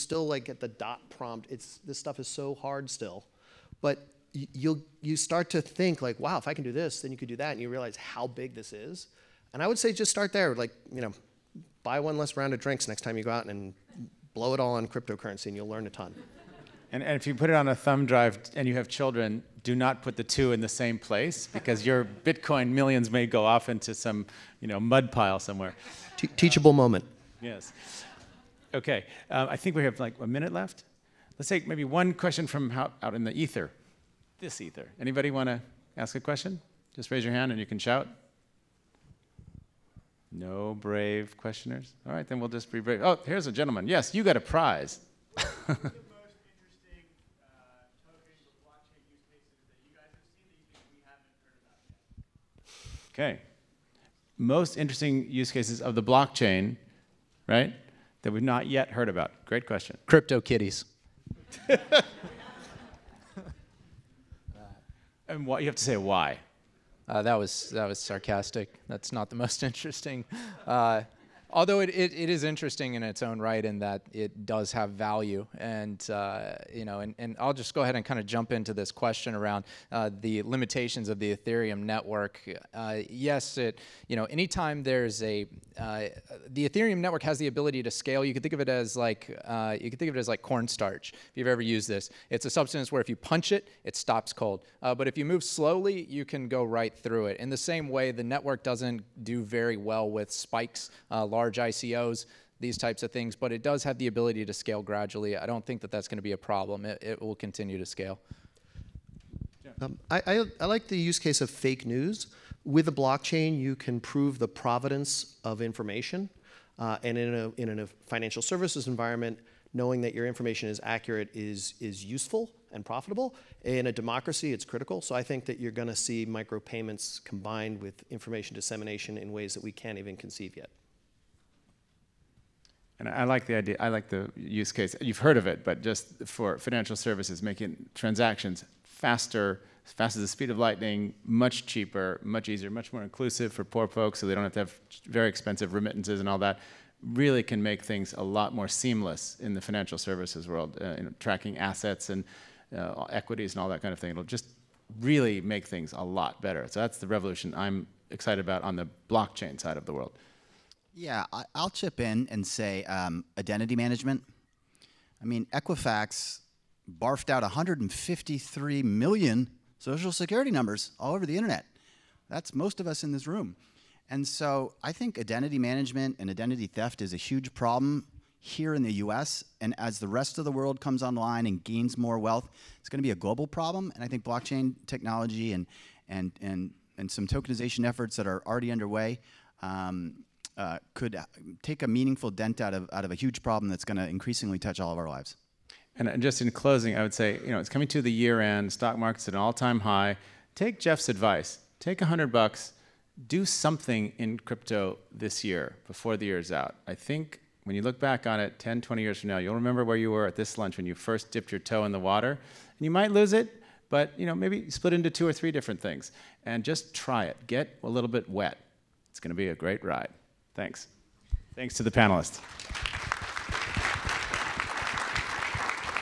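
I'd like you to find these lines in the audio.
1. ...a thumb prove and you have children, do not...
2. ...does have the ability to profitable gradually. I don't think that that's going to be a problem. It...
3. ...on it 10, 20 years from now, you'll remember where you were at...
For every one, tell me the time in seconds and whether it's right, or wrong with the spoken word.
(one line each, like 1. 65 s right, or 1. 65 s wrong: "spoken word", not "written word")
1. 17 s wrong: "drive", not "prove"
2. 103 s wrong: "scale", not "profitable"
3. 208 s right.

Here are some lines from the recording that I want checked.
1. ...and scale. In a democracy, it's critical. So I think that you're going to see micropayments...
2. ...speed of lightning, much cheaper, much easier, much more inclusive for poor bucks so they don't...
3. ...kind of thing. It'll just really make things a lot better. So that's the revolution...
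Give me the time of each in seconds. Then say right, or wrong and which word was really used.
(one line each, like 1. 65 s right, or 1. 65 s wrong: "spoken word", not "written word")
1. 122 s wrong: "profitable", not "scale"
2. 140 s wrong: "folks", not "bucks"
3. 153 s right.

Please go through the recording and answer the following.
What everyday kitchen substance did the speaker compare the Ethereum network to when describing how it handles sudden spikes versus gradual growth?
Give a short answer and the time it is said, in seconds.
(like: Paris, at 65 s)
Cornstarch, at 90 s.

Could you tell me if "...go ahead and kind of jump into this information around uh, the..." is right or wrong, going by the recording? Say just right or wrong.
wrong.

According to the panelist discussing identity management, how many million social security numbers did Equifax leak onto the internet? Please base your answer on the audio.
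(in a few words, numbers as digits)
153 million.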